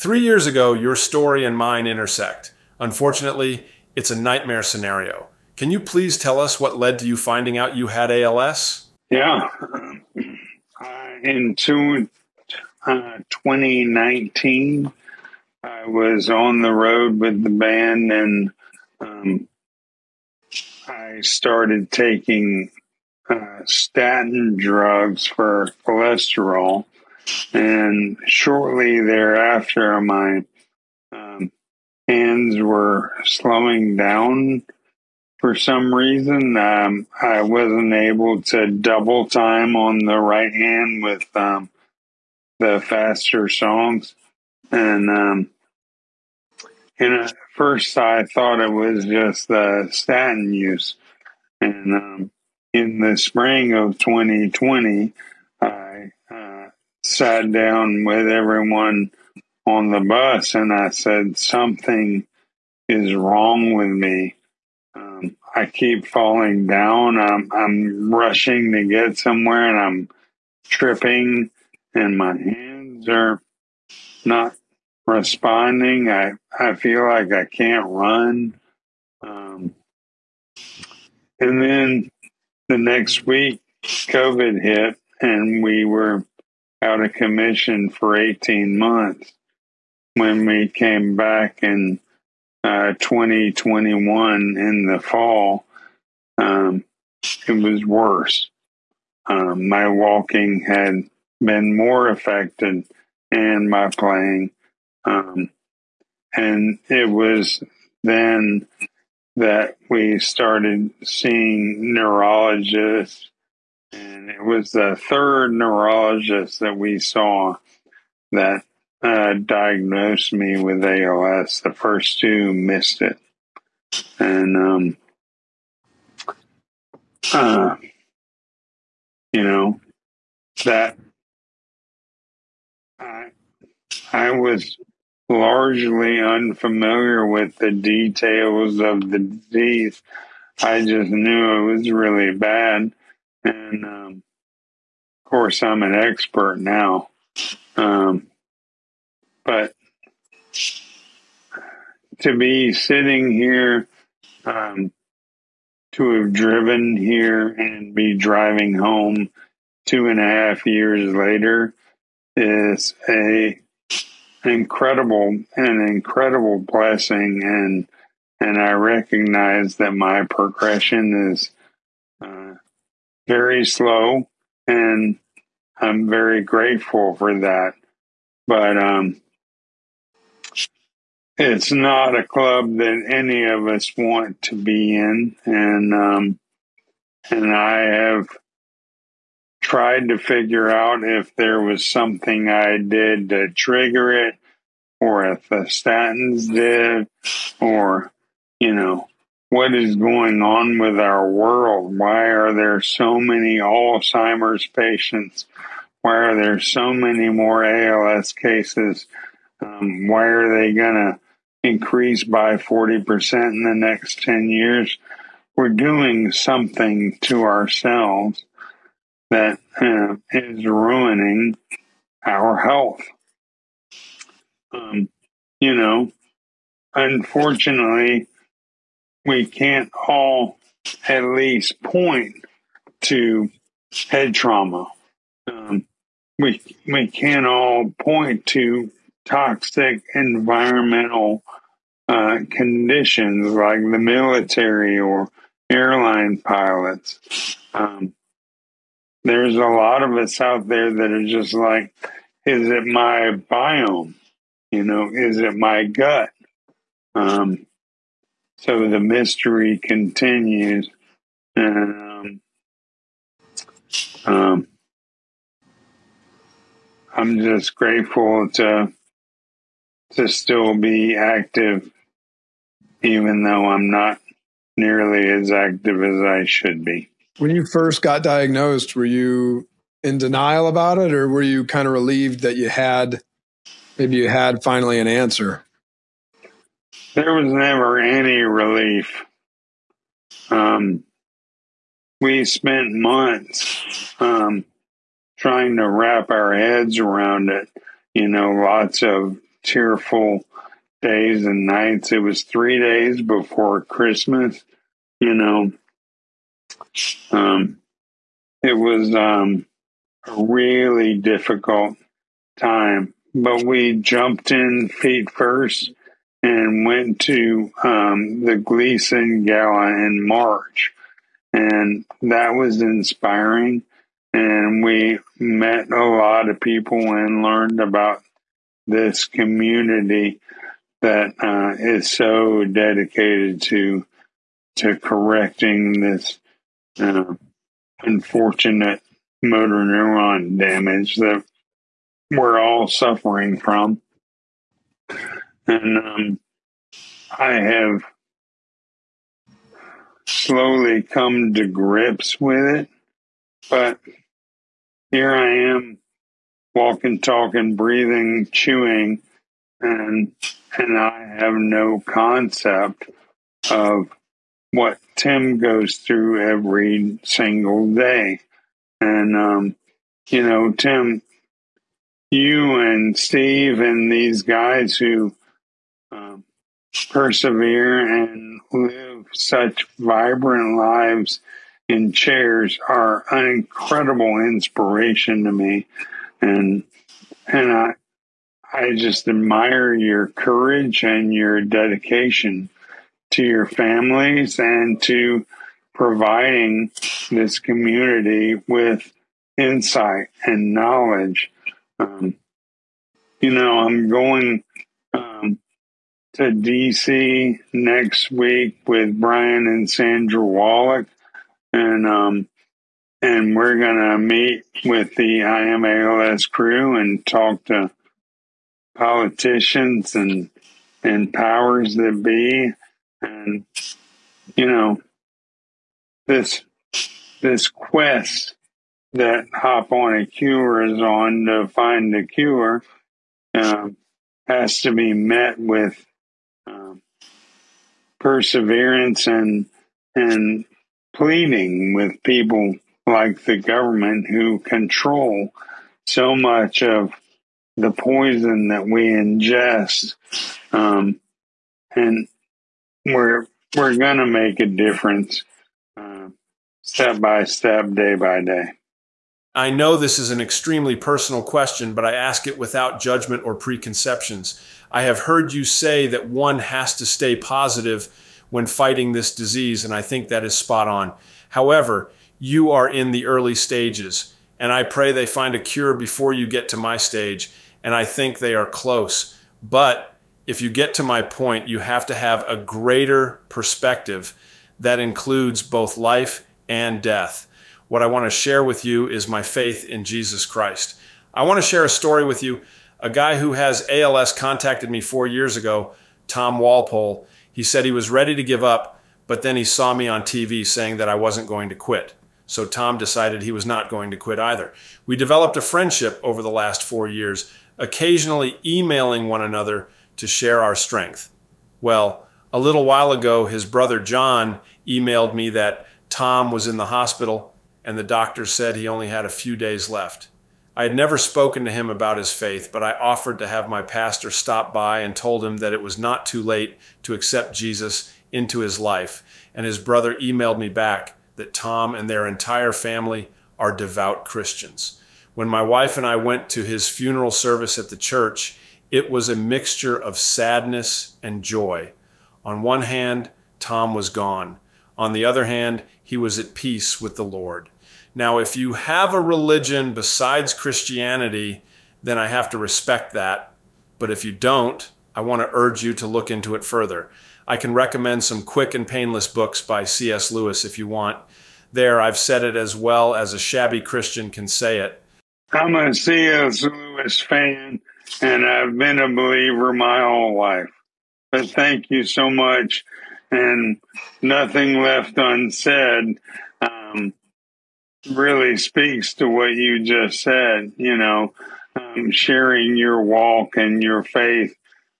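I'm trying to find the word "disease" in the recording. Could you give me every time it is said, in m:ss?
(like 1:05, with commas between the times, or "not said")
2:19, 7:49.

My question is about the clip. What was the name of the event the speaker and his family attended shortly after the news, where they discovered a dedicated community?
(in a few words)
Gleason Gala.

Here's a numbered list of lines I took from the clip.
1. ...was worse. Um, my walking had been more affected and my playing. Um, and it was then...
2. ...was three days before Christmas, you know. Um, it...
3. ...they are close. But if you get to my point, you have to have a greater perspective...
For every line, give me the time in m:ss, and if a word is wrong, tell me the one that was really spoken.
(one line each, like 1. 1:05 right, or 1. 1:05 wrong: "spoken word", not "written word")
1. 1:37 right
2. 5:02 right
3. 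7:58 right.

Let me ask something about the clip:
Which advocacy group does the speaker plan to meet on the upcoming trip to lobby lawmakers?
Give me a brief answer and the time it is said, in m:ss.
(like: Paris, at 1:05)
I AM ALS, at 6:55.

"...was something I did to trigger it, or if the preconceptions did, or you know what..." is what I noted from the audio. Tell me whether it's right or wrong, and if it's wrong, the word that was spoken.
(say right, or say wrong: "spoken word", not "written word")
wrong: "statins", not "preconceptions".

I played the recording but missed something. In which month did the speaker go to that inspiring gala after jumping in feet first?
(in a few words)
March.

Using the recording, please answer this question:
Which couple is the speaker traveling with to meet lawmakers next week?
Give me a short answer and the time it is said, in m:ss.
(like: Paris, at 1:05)
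Brian and Sandra Wallach, at 6:49.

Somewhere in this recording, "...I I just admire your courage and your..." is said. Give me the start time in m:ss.
6:27.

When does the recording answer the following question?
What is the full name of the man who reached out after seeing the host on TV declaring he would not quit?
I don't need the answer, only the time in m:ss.
8:16.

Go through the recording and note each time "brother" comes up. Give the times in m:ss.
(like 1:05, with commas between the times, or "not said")
8:33, 8:49.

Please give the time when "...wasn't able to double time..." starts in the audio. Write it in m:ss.
0:37.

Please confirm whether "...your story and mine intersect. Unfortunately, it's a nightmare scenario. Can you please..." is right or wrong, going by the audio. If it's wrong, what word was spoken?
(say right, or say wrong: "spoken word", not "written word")
right.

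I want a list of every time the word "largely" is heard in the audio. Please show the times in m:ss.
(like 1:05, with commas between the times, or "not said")
2:15.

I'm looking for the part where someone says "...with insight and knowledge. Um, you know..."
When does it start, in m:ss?
6:38.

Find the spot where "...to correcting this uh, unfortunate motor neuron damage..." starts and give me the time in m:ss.
5:34.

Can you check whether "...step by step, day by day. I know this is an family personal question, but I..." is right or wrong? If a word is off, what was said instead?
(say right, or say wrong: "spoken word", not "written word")
wrong: "extremely", not "family".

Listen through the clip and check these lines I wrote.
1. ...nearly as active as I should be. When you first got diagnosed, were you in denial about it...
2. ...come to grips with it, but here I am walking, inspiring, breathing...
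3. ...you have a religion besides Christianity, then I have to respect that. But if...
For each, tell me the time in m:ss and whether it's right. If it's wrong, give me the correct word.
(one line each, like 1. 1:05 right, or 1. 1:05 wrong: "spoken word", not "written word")
1. 4:34 right
2. 5:51 wrong: "talking", not "inspiring"
3. 9:08 right.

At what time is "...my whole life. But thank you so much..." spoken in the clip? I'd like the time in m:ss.
9:29.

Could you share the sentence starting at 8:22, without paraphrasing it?
So Tom decided he was not going to quit either.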